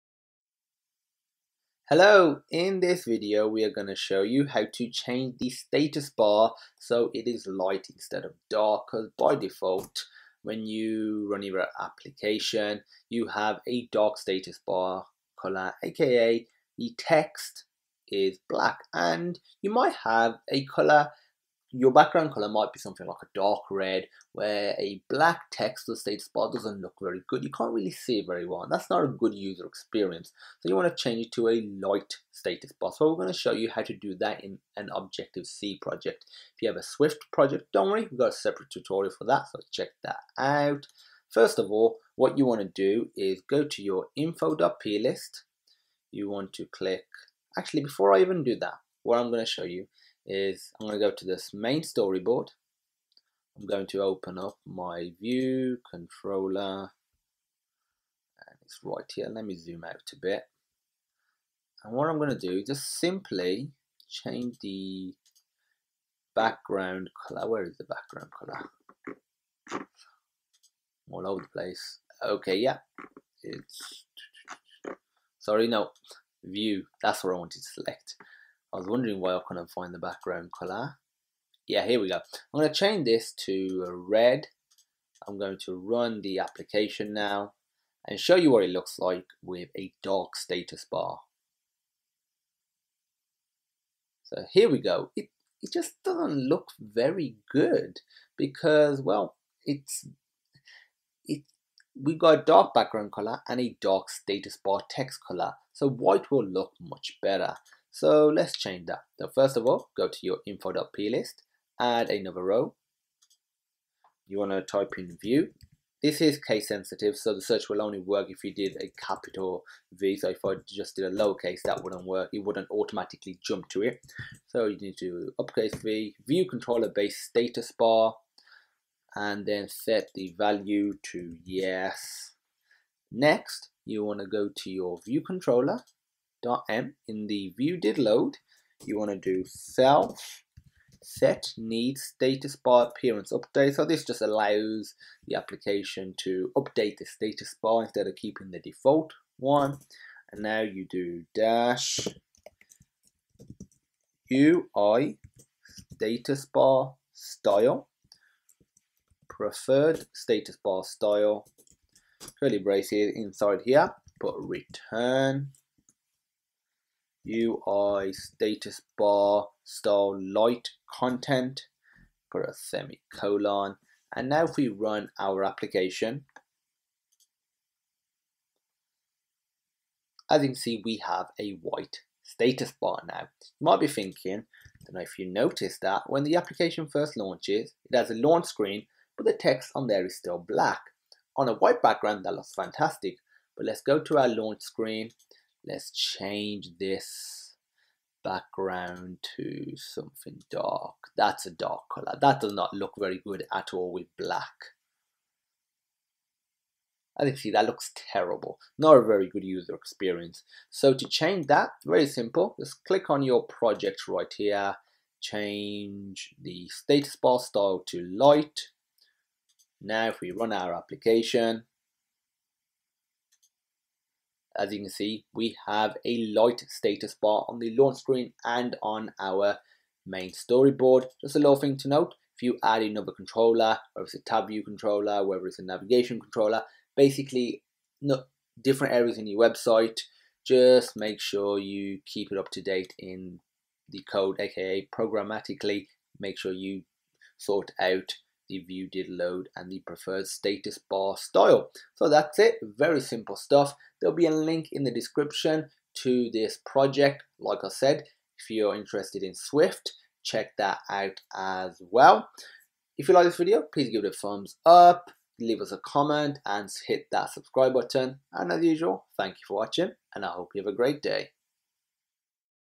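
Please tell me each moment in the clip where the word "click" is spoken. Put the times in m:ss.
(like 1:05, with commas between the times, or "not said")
0:46, 3:32.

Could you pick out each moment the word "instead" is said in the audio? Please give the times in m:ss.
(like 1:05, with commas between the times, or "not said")
0:07, 2:27.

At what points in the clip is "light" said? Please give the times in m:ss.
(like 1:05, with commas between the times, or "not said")
0:07, 0:31, 2:50, 3:38, 3:46.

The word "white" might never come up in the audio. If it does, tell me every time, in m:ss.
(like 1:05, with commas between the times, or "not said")
1:45, 3:01, 3:11.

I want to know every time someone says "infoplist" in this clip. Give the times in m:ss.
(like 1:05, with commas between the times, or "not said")
0:44, 1:50.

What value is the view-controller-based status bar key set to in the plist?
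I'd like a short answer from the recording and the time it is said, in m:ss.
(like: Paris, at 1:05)
yes, at 2:11.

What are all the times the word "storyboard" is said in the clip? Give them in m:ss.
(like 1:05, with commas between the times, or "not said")
0:51, 3:50.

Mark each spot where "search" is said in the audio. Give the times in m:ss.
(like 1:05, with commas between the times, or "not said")
1:57.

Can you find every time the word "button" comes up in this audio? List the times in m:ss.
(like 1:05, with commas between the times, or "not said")
4:27.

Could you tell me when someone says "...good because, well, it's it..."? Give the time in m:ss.
1:37.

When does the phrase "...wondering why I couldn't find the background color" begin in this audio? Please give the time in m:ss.
1:18.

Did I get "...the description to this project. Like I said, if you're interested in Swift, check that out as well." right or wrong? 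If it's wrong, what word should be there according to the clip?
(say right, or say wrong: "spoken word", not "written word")
right.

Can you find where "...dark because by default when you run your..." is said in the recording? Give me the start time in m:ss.
0:08.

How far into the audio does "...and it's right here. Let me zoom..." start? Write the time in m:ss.
0:56.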